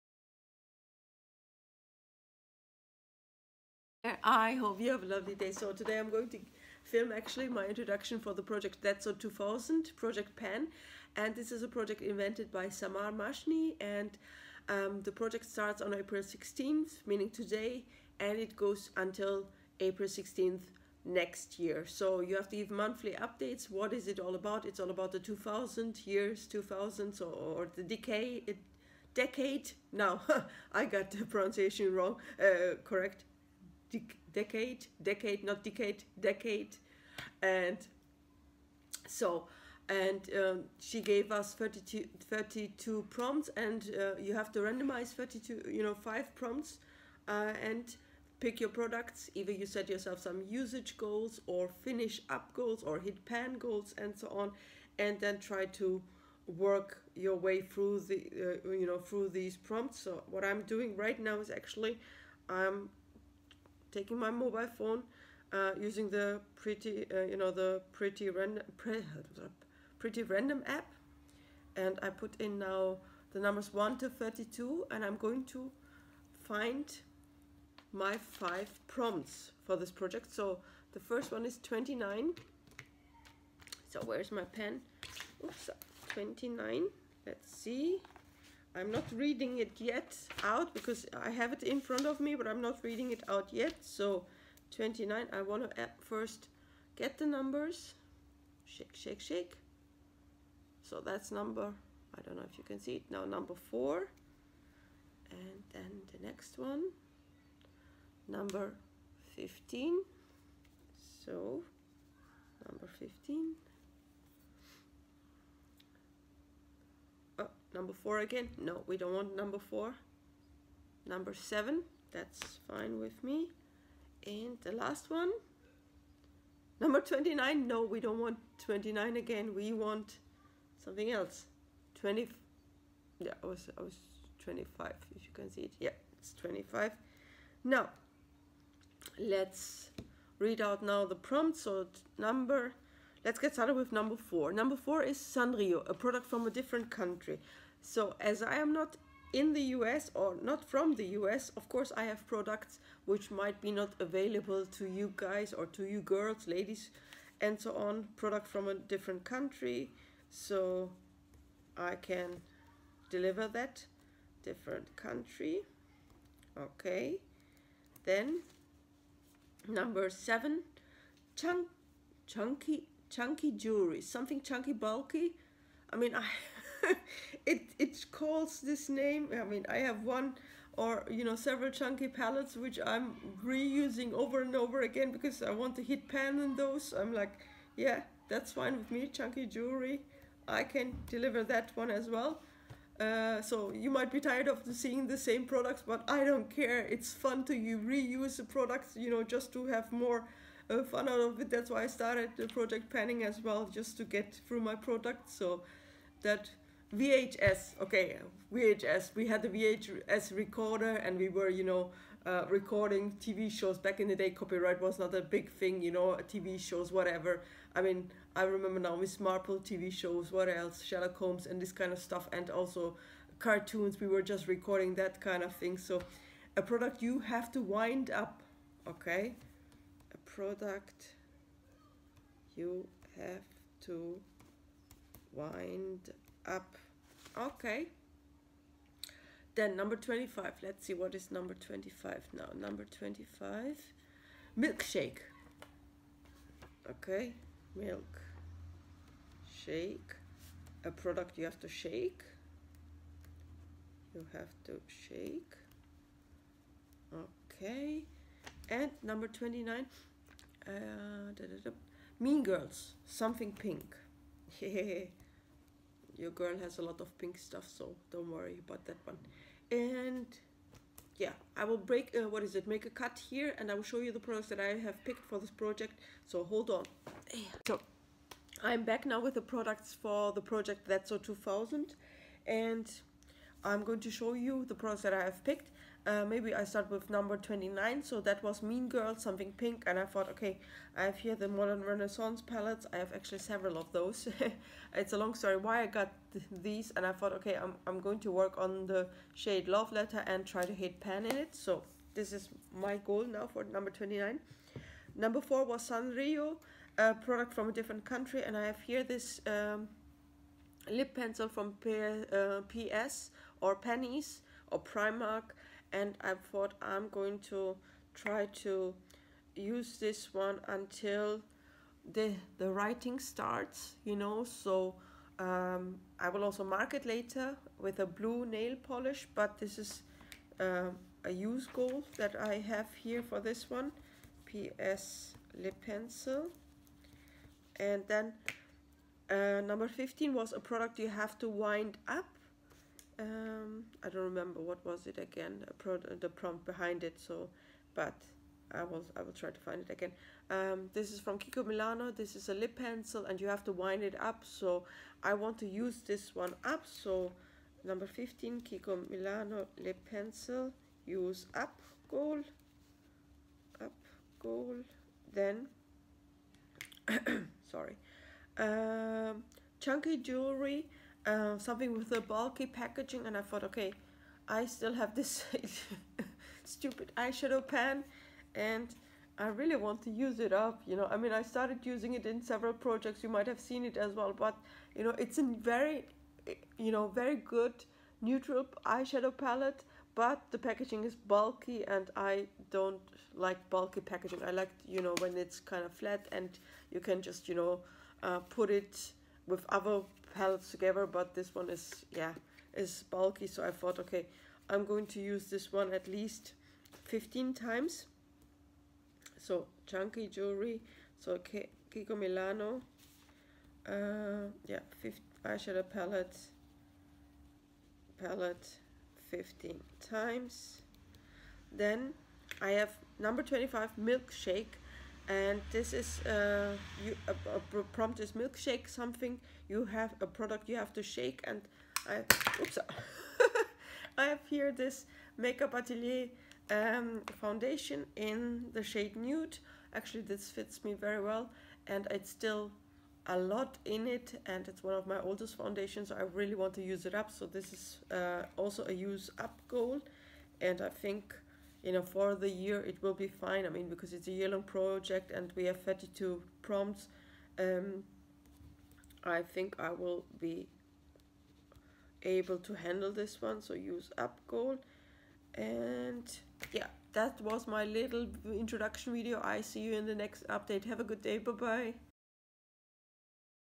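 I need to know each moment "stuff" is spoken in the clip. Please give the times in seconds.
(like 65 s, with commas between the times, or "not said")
221 s, 267 s.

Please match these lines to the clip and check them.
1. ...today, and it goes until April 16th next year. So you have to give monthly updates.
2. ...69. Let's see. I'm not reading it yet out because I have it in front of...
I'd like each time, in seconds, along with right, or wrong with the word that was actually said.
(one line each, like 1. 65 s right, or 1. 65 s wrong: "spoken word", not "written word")
1. 17 s right
2. 86 s wrong: "29", not "69".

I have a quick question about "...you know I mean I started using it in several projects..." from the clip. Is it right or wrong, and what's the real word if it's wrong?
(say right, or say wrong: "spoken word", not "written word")
right.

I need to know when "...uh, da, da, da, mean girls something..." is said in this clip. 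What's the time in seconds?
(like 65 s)
260 s.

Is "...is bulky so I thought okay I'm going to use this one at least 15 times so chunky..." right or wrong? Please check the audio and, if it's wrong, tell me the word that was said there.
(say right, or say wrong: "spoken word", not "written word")
right.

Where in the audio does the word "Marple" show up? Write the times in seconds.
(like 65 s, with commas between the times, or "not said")
219 s.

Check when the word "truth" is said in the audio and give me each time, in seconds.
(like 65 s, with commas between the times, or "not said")
not said.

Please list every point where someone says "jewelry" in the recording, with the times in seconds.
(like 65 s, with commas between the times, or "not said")
173 s, 189 s, 370 s, 410 s.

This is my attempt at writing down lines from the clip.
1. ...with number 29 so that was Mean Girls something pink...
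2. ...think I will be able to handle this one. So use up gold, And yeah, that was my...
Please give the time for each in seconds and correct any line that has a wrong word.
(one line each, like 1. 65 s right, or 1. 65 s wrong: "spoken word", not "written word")
1. 286 s right
2. 459 s right.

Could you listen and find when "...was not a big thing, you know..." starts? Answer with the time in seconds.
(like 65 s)
214 s.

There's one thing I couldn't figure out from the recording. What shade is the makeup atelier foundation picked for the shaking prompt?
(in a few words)
Nude.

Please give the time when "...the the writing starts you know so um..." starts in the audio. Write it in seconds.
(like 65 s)
322 s.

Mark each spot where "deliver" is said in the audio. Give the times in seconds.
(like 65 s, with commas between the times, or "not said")
163 s, 191 s.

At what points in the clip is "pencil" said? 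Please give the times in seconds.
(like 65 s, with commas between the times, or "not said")
311 s, 335 s, 352 s, 360 s.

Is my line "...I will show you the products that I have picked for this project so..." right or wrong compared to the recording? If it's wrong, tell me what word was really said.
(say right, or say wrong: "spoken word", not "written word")
right.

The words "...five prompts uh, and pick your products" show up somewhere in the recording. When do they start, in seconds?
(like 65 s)
45 s.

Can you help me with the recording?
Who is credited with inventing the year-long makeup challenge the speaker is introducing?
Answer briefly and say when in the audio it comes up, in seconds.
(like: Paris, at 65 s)
Samar Mashni, at 12 s.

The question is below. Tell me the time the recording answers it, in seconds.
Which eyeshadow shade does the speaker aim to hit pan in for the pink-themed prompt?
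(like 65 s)
299 s.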